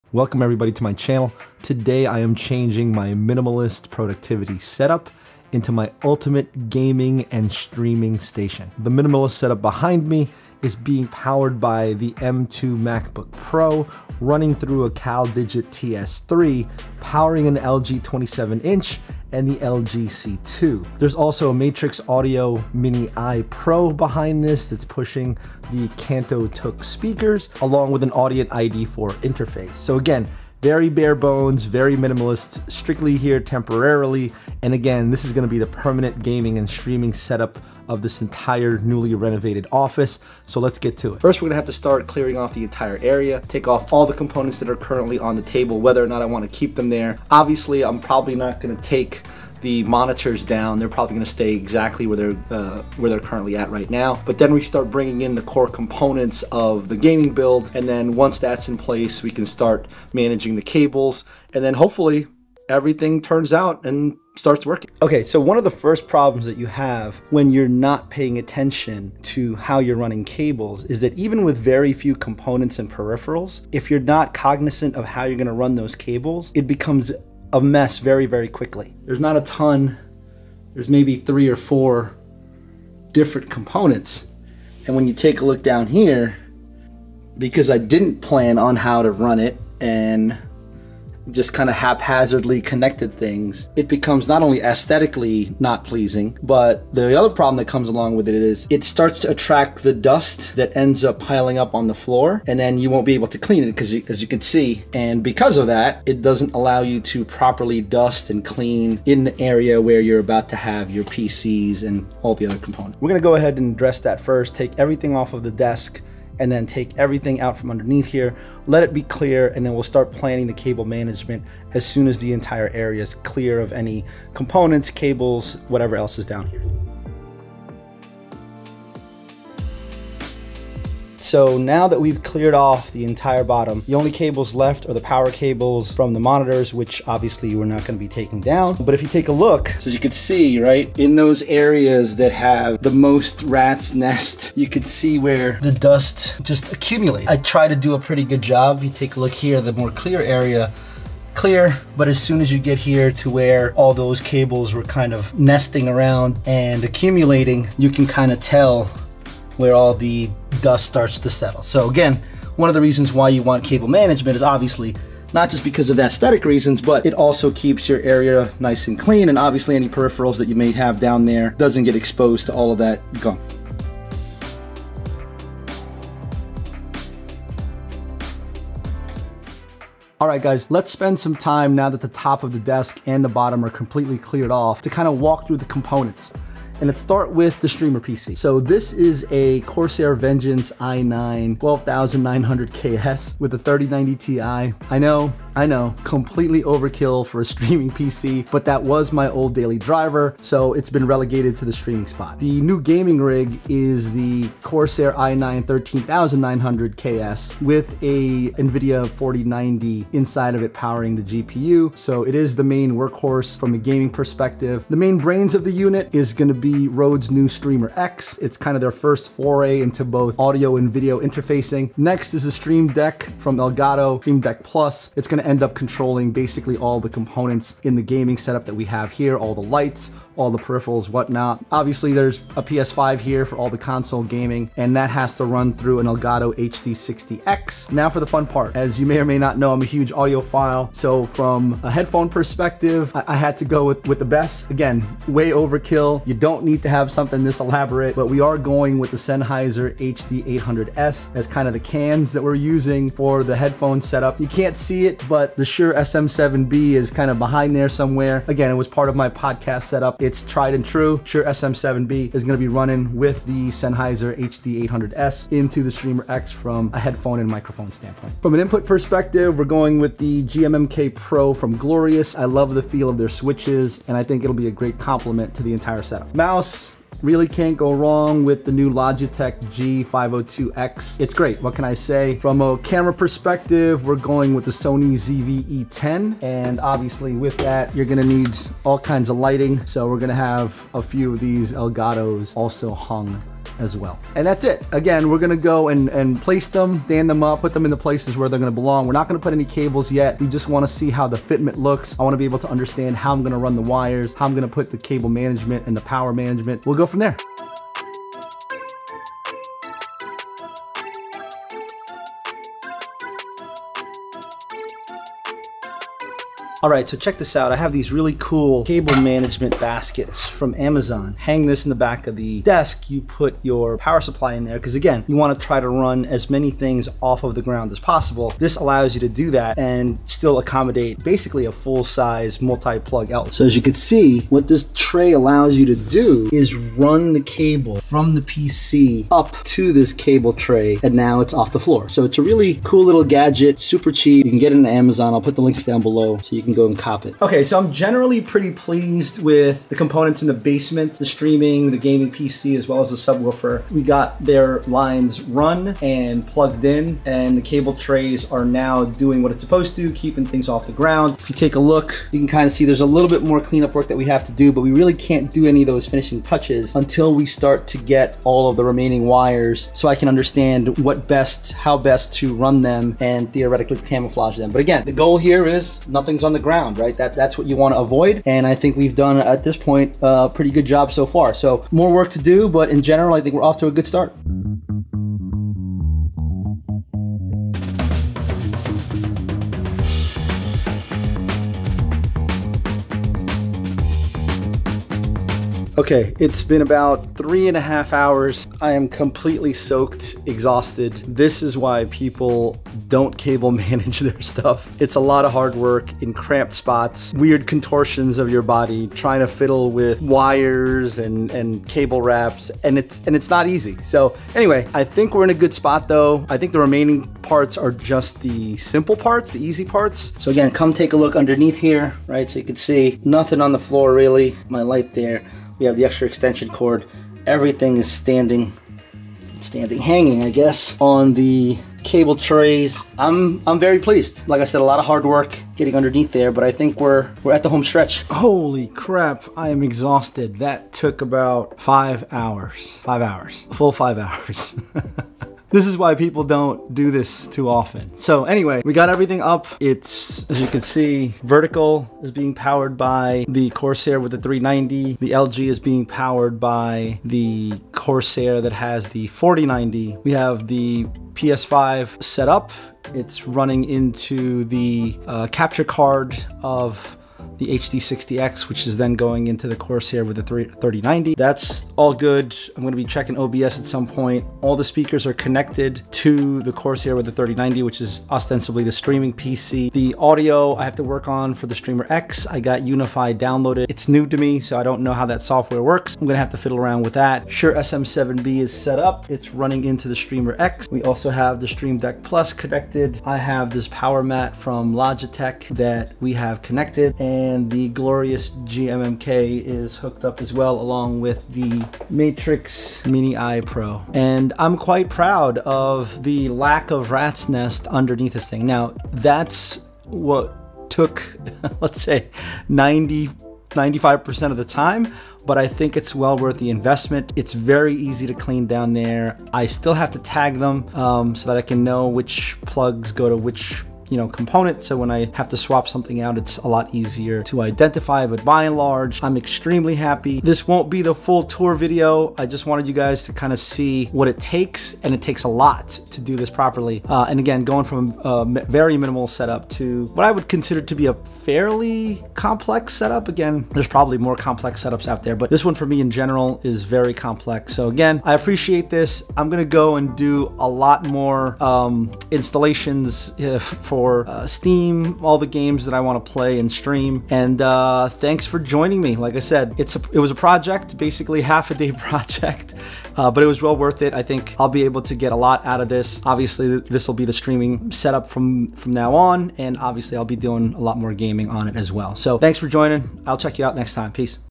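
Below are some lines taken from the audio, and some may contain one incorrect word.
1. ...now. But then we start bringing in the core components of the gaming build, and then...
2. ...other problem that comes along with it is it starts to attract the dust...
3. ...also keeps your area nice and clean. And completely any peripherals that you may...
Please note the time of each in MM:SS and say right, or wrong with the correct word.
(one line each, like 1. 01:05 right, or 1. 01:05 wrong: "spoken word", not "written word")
1. 00:53 right
2. 01:37 right
3. 02:47 wrong: "obviously", not "completely".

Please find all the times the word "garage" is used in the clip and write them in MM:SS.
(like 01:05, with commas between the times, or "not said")
not said.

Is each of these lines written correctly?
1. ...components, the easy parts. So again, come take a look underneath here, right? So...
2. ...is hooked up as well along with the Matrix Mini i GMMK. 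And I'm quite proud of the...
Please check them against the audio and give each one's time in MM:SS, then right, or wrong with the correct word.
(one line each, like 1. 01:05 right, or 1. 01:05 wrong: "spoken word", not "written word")
1. 06:59 wrong: "parts", not "components"
2. 08:19 wrong: "Pro", not "GMMK".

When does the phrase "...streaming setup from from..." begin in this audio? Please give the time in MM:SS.
09:27.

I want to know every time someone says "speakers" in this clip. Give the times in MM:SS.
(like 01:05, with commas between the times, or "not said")
00:26, 07:54.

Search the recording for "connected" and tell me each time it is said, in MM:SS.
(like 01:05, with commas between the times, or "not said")
01:32, 07:55, 08:12, 08:16.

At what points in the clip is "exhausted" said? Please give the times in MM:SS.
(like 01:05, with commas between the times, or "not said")
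06:40, 07:19.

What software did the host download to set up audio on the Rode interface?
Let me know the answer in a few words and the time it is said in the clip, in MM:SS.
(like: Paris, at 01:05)
Unify, at 08:02.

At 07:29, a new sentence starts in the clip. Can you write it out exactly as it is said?
It's, as you can see, vertical is being powered by the Corsair with the 390.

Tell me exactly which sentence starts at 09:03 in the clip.
Again, there's probably more complex setups out there, but this one for me in general is very complex.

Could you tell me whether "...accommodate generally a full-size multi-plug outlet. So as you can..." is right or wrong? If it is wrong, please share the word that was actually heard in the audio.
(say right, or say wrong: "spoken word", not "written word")
wrong: "basically", not "generally".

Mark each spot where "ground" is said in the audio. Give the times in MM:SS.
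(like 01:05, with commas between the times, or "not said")
05:27, 06:00, 06:16.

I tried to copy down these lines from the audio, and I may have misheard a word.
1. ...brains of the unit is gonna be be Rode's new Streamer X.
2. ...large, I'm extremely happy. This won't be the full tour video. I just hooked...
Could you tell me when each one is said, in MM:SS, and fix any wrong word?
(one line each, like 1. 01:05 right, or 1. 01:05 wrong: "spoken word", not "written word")
1. 03:35 right
2. 08:48 wrong: "wanted", not "hooked".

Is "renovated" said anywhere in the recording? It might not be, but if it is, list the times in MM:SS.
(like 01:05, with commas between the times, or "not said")
00:39.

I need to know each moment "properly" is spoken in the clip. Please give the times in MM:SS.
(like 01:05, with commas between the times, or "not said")
01:47, 08:56.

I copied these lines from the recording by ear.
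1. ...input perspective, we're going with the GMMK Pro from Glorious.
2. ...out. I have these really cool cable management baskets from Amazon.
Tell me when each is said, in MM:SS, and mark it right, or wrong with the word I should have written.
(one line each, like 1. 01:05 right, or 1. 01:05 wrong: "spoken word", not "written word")
1. 04:28 right
2. 05:17 right.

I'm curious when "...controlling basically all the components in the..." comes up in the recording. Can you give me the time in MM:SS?
03:45.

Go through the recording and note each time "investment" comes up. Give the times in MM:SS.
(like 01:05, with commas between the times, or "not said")
08:36.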